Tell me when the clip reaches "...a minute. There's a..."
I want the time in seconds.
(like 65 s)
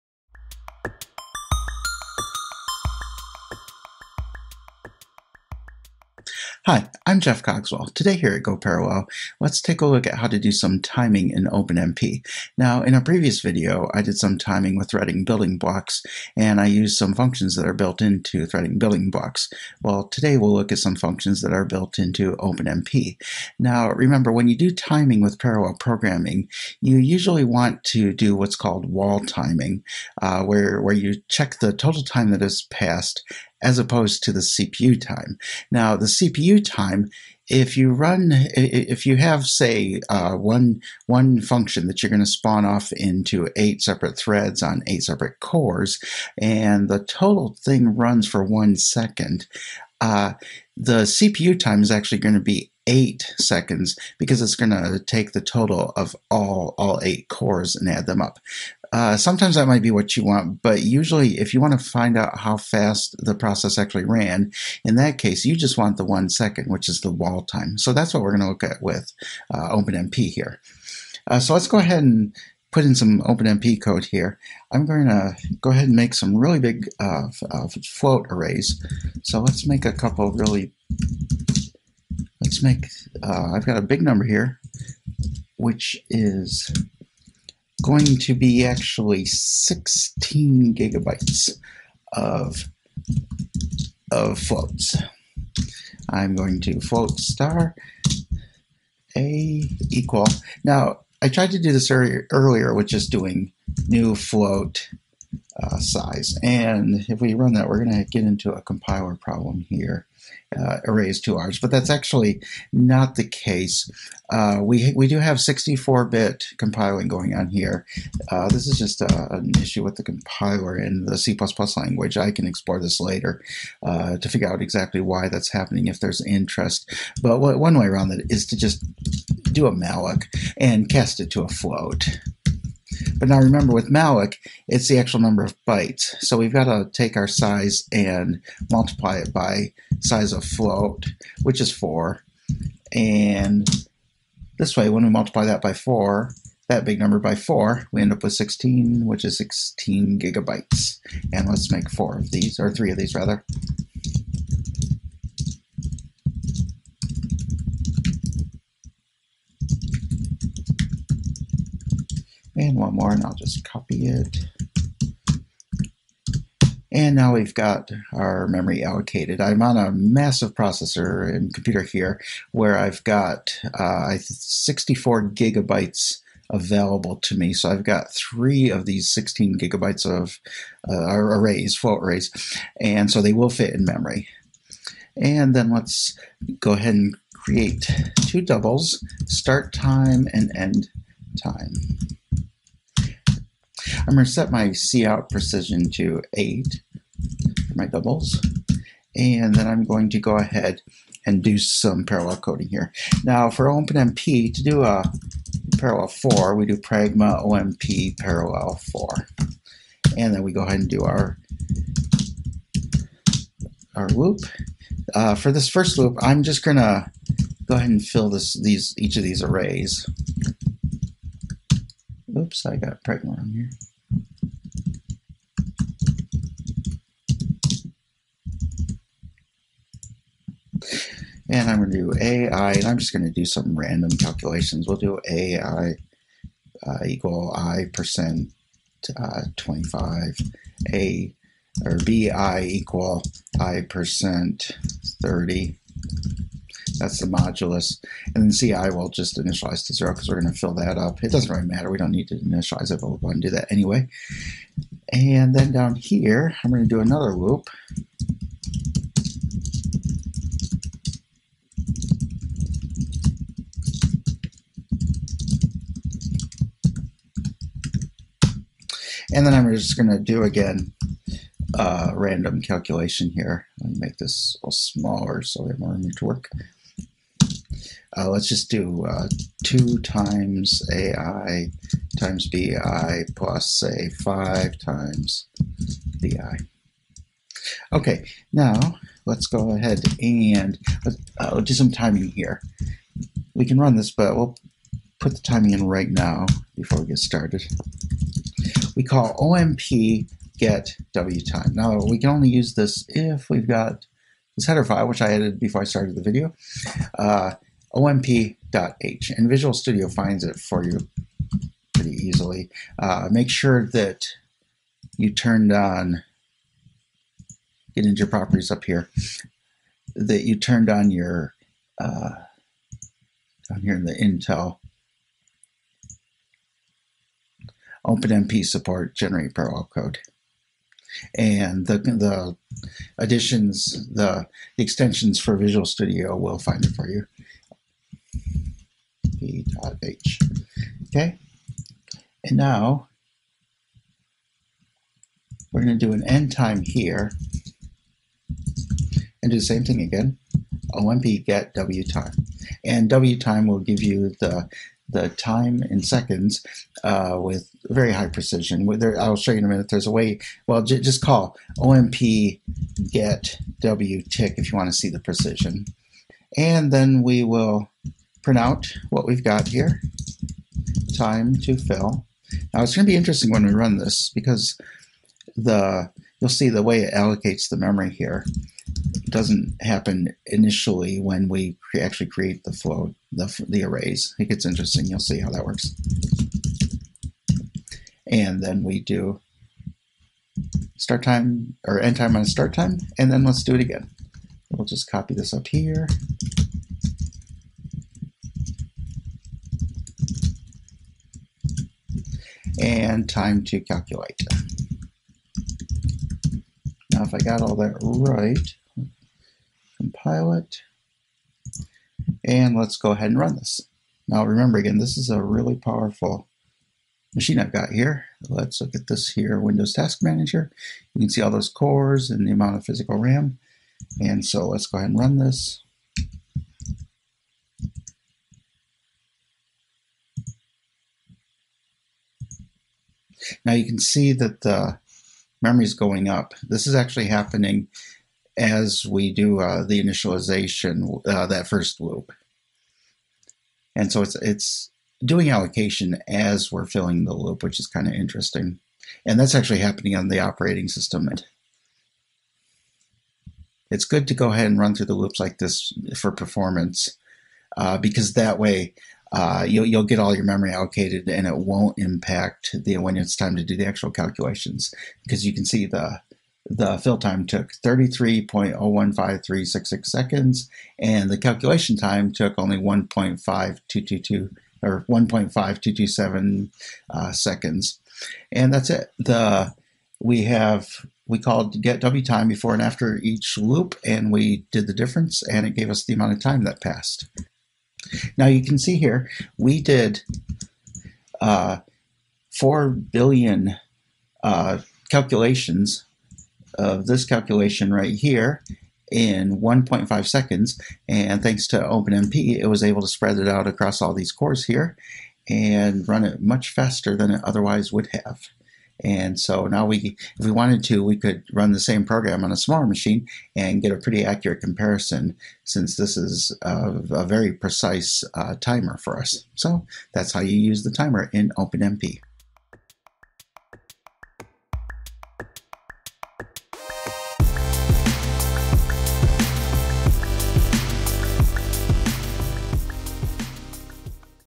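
359 s.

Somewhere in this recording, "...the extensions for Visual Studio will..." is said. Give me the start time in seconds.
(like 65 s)
334 s.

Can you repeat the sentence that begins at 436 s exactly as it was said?
This is actually happening as we do uh, the initialization, uh, that first loop.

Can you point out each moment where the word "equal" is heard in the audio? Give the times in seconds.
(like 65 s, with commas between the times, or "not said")
99 s, 237 s, 242 s.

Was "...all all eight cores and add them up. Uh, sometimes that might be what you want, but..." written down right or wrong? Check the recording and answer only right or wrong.
right.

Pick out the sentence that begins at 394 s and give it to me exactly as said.
We'll just copy this up here.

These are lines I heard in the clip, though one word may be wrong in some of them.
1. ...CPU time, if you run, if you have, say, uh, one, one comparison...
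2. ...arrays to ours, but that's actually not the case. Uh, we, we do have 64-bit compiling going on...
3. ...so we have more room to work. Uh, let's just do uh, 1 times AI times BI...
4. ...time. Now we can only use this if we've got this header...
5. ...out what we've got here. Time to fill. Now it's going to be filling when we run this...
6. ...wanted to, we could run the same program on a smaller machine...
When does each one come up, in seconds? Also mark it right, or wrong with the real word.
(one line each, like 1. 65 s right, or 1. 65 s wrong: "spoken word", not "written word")
1. 36 s wrong: "function", not "comparison"
2. 110 s right
3. 275 s wrong: "2", not "1"
4. 301 s right
5. 368 s wrong: "interesting", not "filling"
6. 510 s right.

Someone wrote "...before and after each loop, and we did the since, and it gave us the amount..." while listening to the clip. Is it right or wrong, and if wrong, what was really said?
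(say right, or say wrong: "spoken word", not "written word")
wrong: "difference", not "since".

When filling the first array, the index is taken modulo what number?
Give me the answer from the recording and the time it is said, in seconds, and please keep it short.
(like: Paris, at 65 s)
25, at 239 s.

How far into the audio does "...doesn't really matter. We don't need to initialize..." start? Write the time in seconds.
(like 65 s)
251 s.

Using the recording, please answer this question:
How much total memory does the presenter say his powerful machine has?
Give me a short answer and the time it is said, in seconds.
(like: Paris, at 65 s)
64 gigabytes, at 174 s.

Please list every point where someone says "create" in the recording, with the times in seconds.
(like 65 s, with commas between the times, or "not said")
187 s, 382 s.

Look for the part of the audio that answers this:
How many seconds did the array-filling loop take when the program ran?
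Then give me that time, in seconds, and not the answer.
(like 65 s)
467 s.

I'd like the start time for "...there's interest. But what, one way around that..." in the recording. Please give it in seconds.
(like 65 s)
126 s.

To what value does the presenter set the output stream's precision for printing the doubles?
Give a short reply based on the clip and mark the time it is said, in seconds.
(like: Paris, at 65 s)
8, at 196 s.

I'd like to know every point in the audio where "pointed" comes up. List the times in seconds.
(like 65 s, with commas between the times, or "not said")
not said.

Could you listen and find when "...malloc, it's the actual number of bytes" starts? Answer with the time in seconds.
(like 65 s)
133 s.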